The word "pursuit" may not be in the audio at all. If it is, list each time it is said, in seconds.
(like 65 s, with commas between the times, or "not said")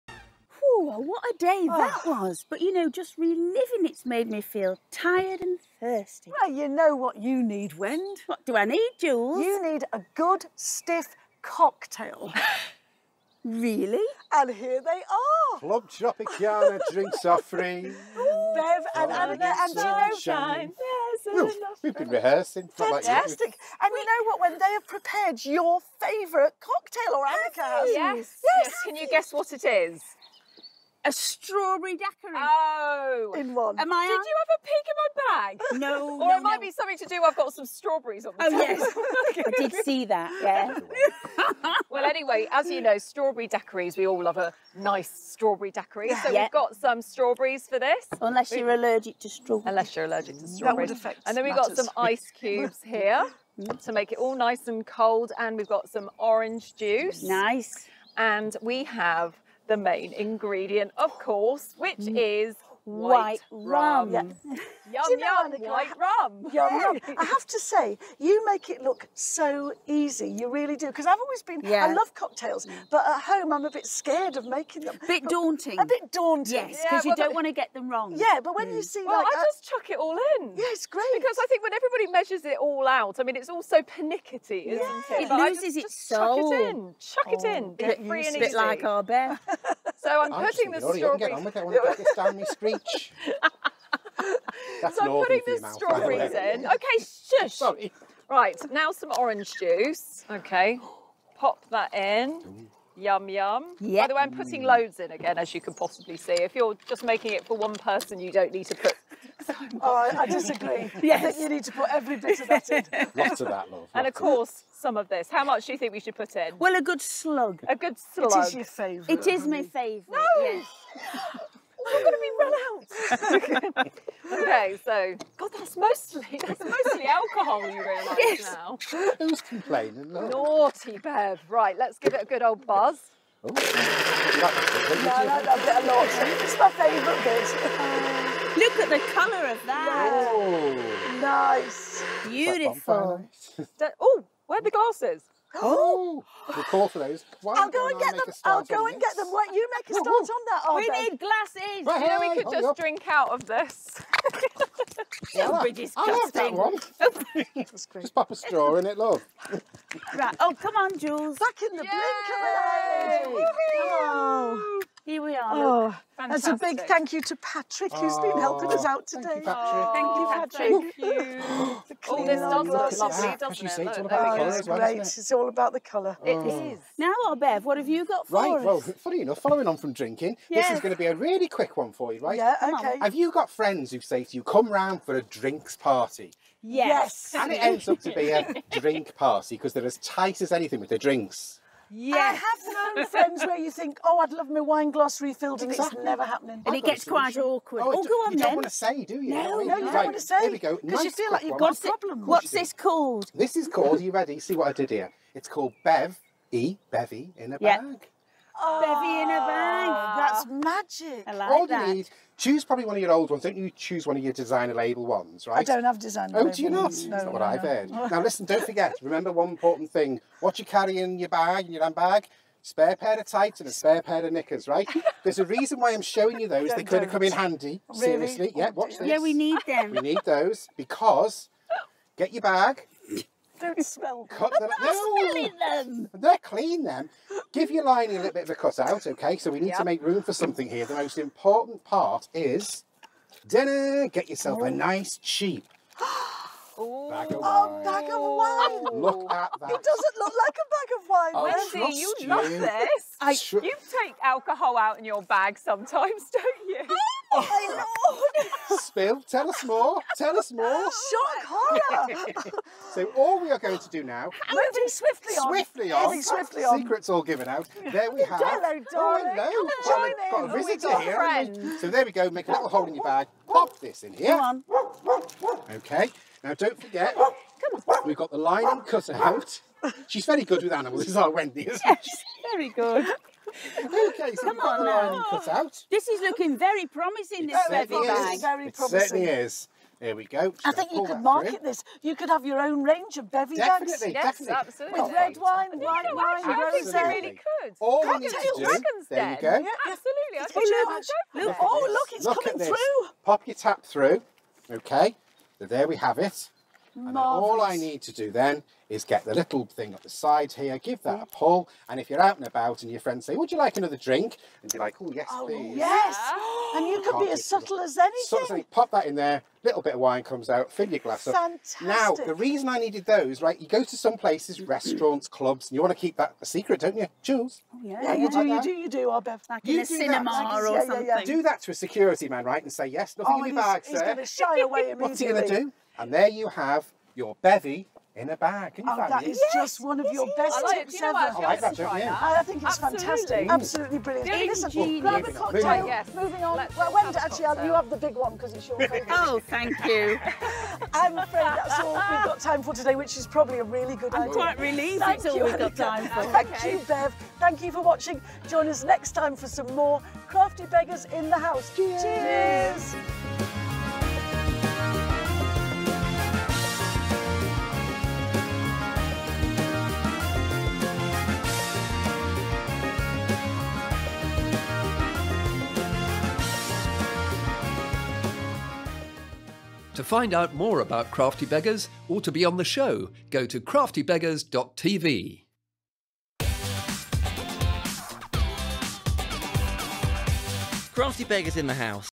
not said.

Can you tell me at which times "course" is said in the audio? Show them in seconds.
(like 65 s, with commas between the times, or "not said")
61 s, 114 s.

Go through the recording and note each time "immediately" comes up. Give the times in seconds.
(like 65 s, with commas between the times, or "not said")
334 s.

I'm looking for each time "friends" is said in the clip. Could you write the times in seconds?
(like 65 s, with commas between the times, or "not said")
183 s, 193 s, 271 s, 312 s.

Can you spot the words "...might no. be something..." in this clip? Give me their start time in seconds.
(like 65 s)
36 s.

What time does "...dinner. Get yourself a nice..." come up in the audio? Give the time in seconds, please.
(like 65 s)
243 s.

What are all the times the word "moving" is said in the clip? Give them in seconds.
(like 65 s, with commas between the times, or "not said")
264 s, 346 s.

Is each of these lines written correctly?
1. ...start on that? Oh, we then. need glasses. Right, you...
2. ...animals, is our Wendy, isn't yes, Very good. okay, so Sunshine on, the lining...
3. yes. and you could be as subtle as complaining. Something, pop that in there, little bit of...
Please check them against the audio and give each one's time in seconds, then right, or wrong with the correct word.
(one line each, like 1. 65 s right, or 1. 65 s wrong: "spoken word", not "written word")
1. 149 s right
2. 280 s wrong: "Come", not "Sunshine"
3. 315 s wrong: "anything", not "complaining".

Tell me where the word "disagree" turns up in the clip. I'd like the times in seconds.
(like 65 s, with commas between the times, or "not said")
110 s.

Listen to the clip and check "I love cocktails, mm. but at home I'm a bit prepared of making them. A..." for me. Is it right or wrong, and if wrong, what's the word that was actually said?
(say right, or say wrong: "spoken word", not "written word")
wrong: "scared", not "prepared".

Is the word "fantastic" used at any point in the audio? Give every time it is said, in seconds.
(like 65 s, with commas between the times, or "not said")
22 s, 166 s, 321 s, 342 s.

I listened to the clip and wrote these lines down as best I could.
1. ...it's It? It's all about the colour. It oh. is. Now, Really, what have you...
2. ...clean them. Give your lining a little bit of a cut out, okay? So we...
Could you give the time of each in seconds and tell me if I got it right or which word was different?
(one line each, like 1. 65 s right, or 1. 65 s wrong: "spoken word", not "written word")
1. 174 s wrong: "Bev", not "Really"
2. 236 s right.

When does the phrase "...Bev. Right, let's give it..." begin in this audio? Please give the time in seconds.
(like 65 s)
130 s.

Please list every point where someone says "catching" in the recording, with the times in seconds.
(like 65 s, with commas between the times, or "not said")
not said.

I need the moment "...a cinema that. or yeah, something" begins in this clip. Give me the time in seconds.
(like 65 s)
329 s.